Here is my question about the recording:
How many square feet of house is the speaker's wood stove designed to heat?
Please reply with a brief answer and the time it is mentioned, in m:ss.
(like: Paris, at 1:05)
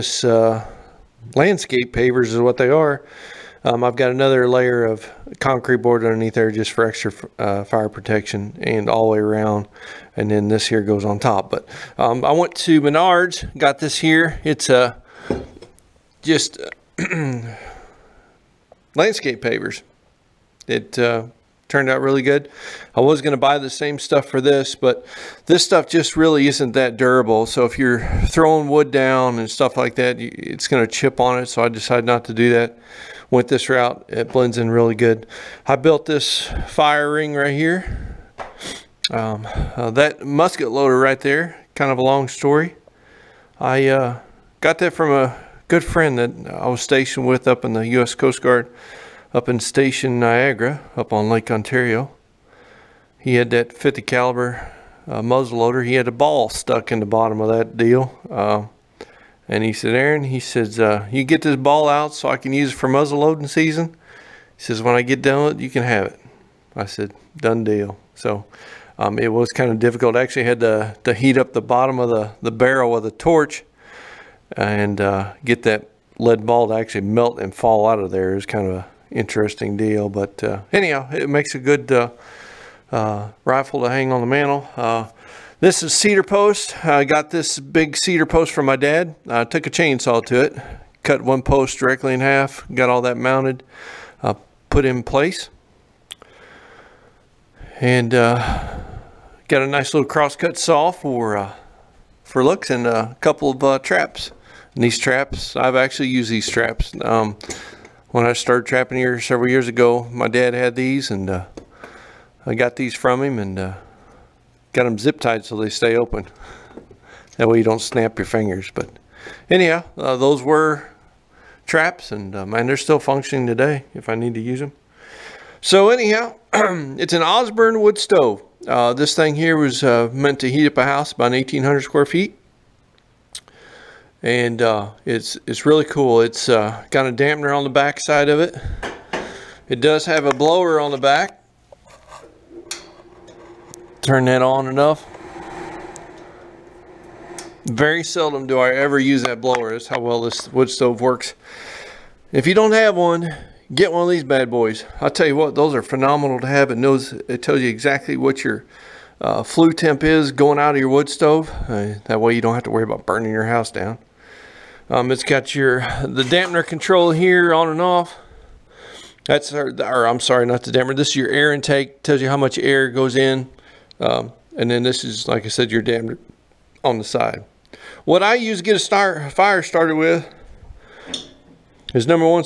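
1,800, at 2:11.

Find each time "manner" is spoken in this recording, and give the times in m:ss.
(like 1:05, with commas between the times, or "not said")
not said.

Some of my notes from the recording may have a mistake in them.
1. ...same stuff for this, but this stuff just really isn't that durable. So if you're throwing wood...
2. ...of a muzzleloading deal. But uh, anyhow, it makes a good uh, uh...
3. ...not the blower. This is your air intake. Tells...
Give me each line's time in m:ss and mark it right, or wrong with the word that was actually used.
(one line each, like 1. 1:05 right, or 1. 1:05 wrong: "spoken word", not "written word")
1. 0:23 right
2. 1:18 wrong: "interesting", not "muzzleloading"
3. 2:50 wrong: "dampener", not "blower".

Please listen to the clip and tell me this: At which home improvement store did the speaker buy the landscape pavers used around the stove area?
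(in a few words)
Menards.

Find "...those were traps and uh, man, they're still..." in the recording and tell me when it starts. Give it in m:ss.
2:00.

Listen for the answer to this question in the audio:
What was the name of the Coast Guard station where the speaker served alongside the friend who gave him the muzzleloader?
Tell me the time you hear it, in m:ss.
0:49.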